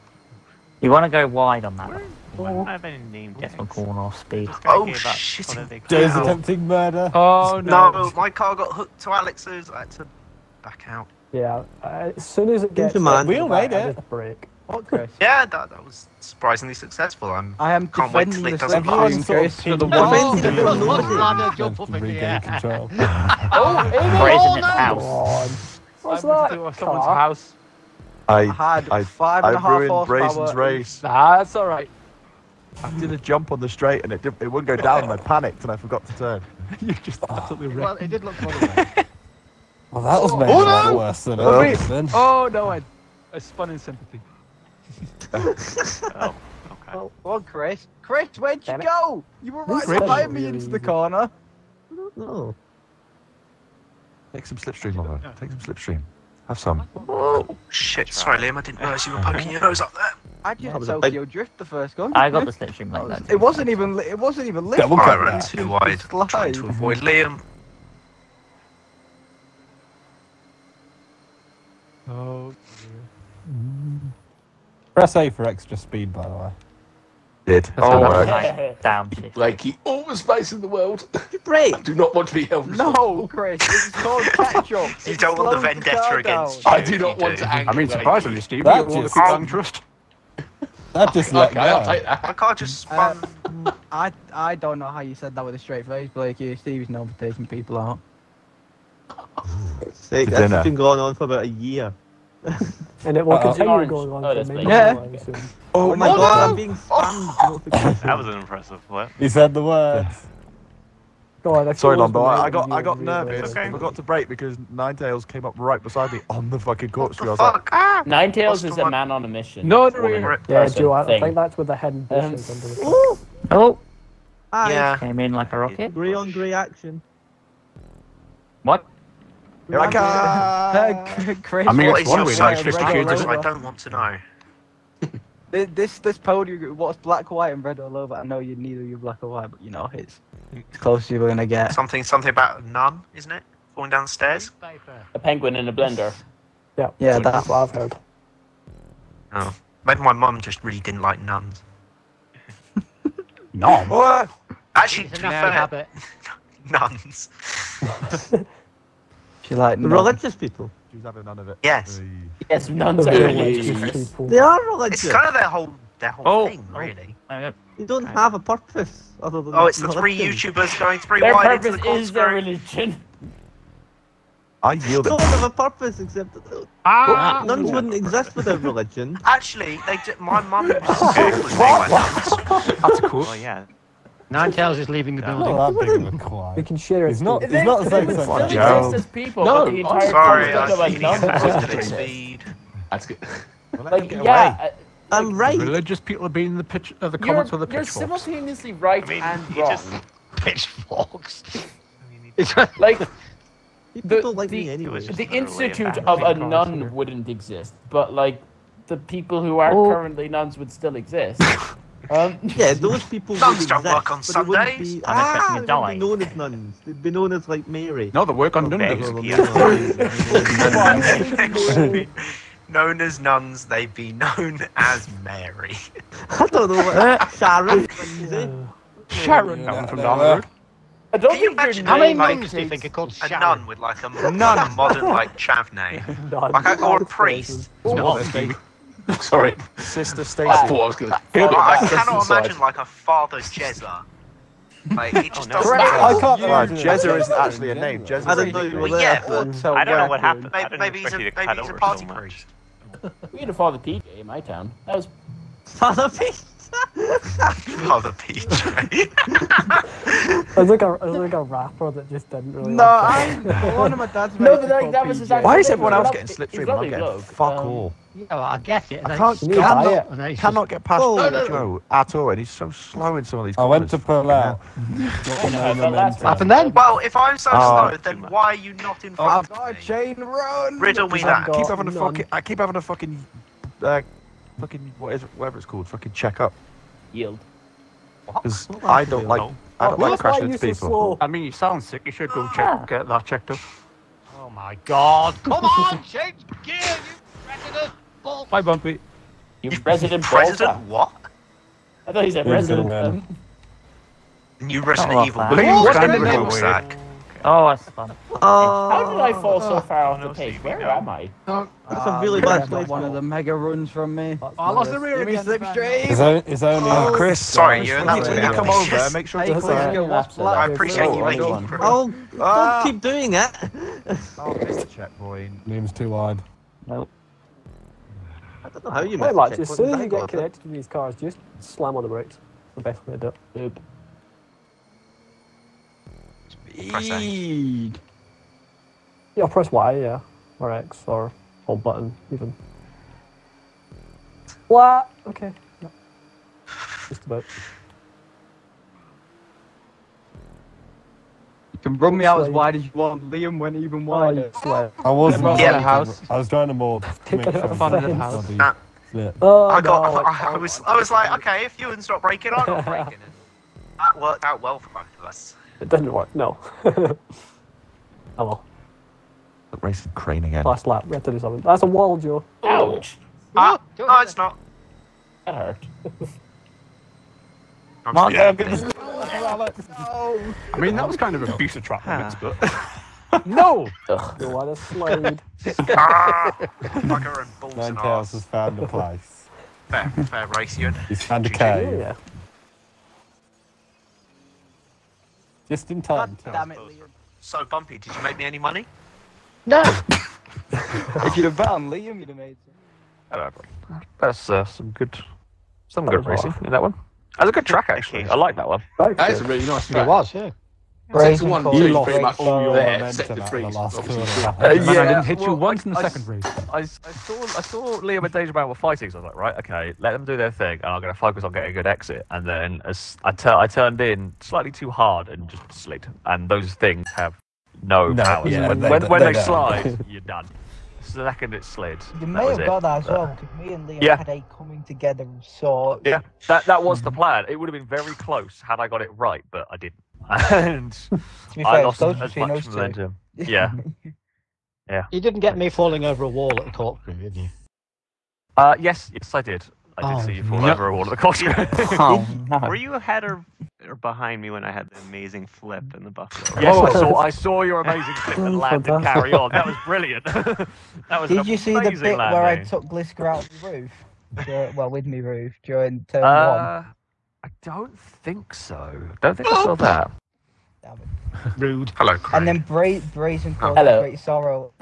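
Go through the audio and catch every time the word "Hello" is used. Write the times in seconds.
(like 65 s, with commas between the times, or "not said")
471 s.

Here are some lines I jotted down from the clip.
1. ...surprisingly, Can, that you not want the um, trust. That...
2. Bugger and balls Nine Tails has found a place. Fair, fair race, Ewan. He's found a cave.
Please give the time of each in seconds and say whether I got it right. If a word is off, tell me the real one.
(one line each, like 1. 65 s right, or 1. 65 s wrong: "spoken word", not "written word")
1. 87 s wrong: "Steve", not "Can"
2. 386 s right.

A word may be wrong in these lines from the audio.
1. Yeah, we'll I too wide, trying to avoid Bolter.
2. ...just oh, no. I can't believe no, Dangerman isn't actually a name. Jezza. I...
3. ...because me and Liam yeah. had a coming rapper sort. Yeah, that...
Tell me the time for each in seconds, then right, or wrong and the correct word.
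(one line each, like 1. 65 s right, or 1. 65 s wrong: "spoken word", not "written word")
1. 64 s wrong: "Liam", not "Bolter"
2. 245 s wrong: "Jezza", not "Dangerman"
3. 433 s wrong: "together", not "rapper".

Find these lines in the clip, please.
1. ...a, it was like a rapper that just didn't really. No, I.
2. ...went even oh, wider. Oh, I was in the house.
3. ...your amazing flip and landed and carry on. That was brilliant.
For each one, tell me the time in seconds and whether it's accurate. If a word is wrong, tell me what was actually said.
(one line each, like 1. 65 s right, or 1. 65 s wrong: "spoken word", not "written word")
1. 260 s right
2. 353 s right
3. 457 s right.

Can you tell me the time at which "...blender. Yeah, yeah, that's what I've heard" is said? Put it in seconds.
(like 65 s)
145 s.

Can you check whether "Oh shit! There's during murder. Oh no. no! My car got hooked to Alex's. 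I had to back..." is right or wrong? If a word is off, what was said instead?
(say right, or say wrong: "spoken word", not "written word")
wrong: "attempting", not "during".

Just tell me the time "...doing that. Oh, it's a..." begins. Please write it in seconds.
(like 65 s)
322 s.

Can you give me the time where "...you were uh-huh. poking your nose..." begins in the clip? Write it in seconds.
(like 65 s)
59 s.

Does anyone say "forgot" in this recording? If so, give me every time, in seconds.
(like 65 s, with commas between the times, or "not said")
35 s, 113 s.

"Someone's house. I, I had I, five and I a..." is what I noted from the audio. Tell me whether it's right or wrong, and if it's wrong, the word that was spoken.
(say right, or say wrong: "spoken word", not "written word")
right.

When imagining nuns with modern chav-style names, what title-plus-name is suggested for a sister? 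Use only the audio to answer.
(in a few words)
Sister Stacy.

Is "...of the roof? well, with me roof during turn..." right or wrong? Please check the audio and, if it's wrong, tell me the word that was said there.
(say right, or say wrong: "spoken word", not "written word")
right.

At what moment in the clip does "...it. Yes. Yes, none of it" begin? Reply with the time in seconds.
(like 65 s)
161 s.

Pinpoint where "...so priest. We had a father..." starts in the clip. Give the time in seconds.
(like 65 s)
252 s.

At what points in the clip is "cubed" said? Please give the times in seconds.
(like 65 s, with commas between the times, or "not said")
132 s.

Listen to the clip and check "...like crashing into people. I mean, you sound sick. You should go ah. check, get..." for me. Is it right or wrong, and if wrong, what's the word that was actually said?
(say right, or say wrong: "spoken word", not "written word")
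right.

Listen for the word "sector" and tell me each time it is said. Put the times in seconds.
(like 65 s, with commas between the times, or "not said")
413 s.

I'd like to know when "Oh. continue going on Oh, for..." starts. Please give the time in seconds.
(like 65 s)
103 s.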